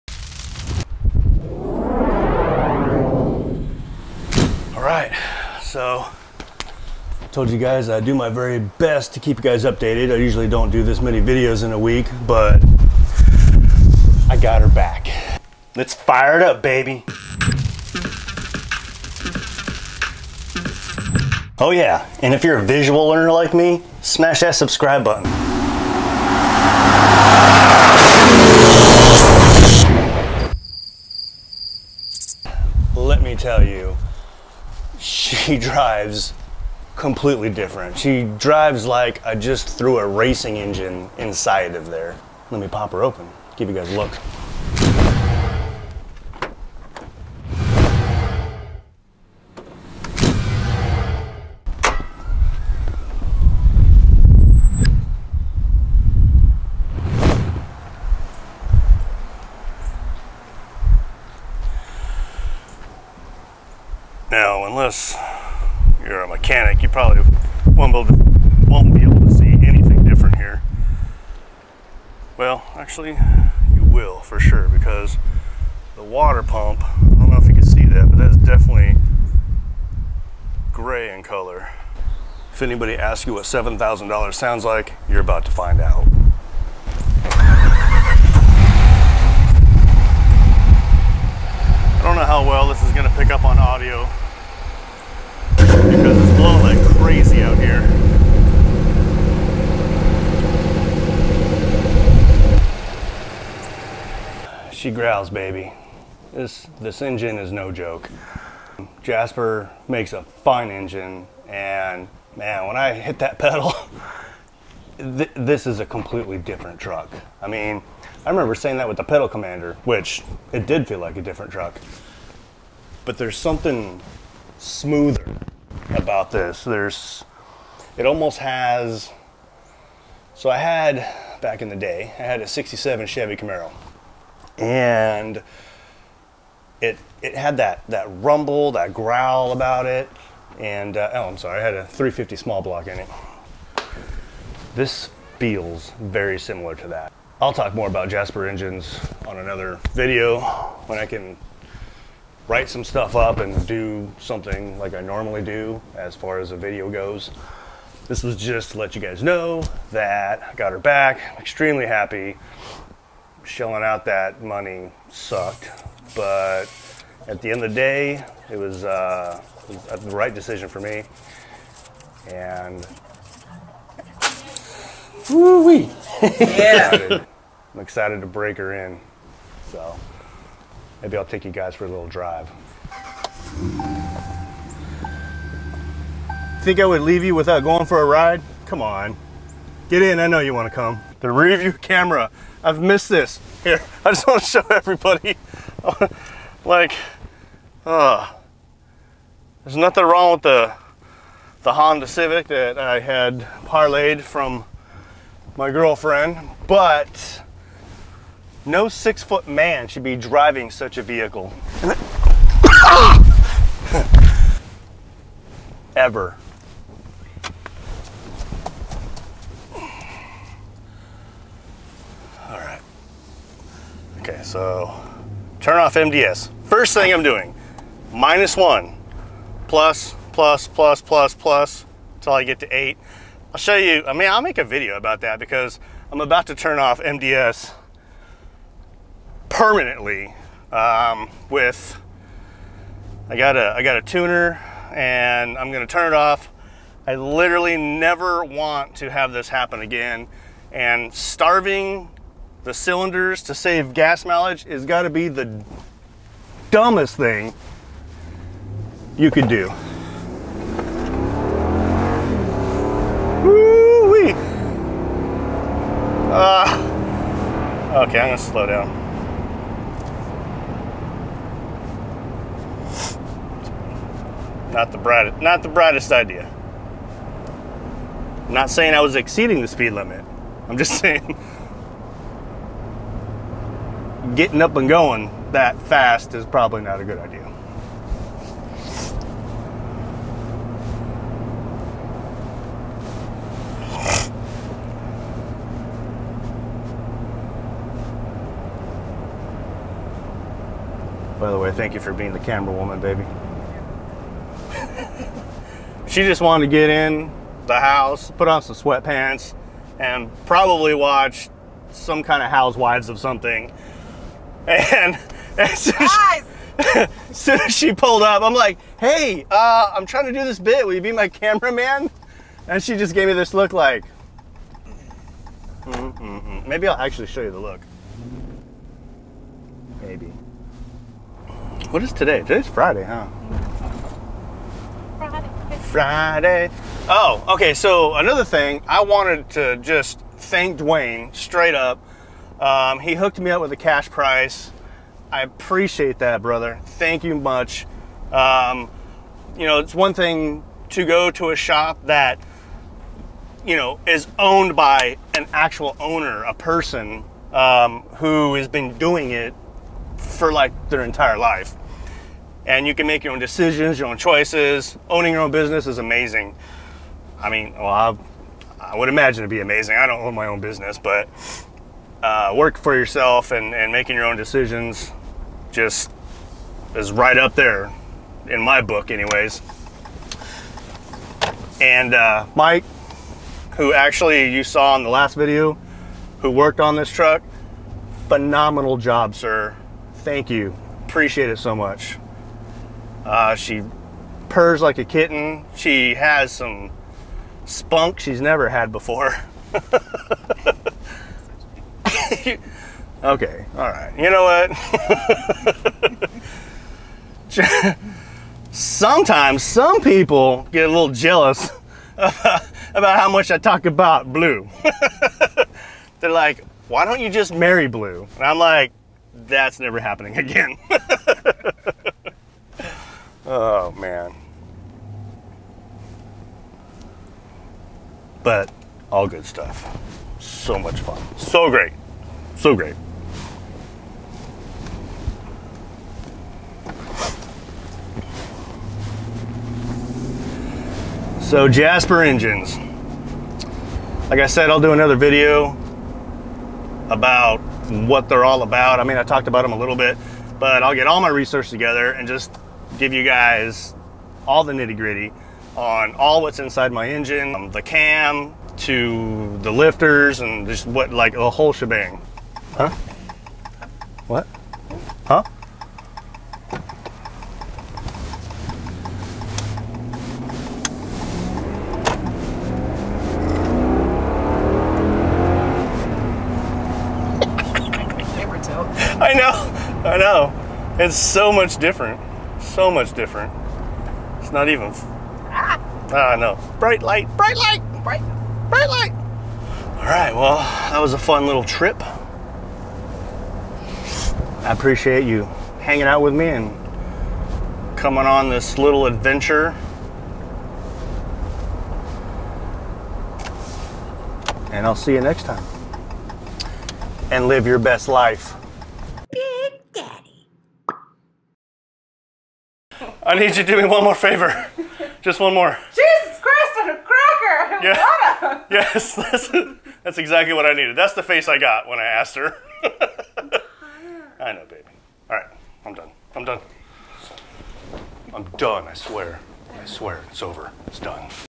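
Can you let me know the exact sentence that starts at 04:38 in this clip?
I'm not saying I was exceeding the speed limit.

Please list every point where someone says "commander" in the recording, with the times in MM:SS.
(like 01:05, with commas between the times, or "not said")
01:59.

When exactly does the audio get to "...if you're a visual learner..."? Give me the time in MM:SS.
00:22.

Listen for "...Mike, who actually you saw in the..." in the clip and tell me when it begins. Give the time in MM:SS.
06:22.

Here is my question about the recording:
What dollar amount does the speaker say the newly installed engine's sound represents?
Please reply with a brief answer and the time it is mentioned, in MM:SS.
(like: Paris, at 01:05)
$7,000, at 01:23.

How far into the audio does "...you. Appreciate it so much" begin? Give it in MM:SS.
06:30.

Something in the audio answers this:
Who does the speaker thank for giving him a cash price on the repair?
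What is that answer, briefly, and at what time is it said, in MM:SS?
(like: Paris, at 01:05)
Dwayne, at 05:40.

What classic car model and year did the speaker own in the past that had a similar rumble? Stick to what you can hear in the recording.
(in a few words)
67 Chevy Camaro.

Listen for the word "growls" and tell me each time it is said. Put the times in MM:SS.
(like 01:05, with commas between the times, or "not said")
01:44, 02:18.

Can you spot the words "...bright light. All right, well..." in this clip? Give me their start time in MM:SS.
08:08.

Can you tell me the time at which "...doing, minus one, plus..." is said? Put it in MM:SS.
03:47.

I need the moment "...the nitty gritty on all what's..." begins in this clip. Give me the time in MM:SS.
07:34.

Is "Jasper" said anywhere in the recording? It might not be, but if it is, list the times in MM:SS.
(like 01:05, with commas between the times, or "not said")
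01:49, 02:28, 07:21.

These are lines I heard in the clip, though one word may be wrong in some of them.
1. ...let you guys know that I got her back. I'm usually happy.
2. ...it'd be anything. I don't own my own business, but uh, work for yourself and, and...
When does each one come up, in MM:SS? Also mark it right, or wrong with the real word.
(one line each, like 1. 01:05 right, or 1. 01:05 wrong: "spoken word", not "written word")
1. 02:38 wrong: "extremely", not "usually"
2. 06:09 wrong: "amazing", not "anything".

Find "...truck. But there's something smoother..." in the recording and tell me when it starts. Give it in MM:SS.
02:01.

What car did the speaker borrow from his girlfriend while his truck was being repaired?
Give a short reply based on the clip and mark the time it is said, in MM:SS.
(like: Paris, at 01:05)
Honda Civic, at 03:21.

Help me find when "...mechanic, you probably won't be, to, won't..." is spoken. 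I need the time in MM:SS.
01:06.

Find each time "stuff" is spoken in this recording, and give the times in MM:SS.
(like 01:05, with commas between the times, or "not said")
02:32, 07:09.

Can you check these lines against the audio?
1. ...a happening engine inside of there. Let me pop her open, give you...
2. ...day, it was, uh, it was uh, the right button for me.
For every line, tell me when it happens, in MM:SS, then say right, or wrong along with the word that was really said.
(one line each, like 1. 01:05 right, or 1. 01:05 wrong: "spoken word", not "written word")
1. 00:39 wrong: "racing", not "happening"
2. 02:47 wrong: "decision", not "button".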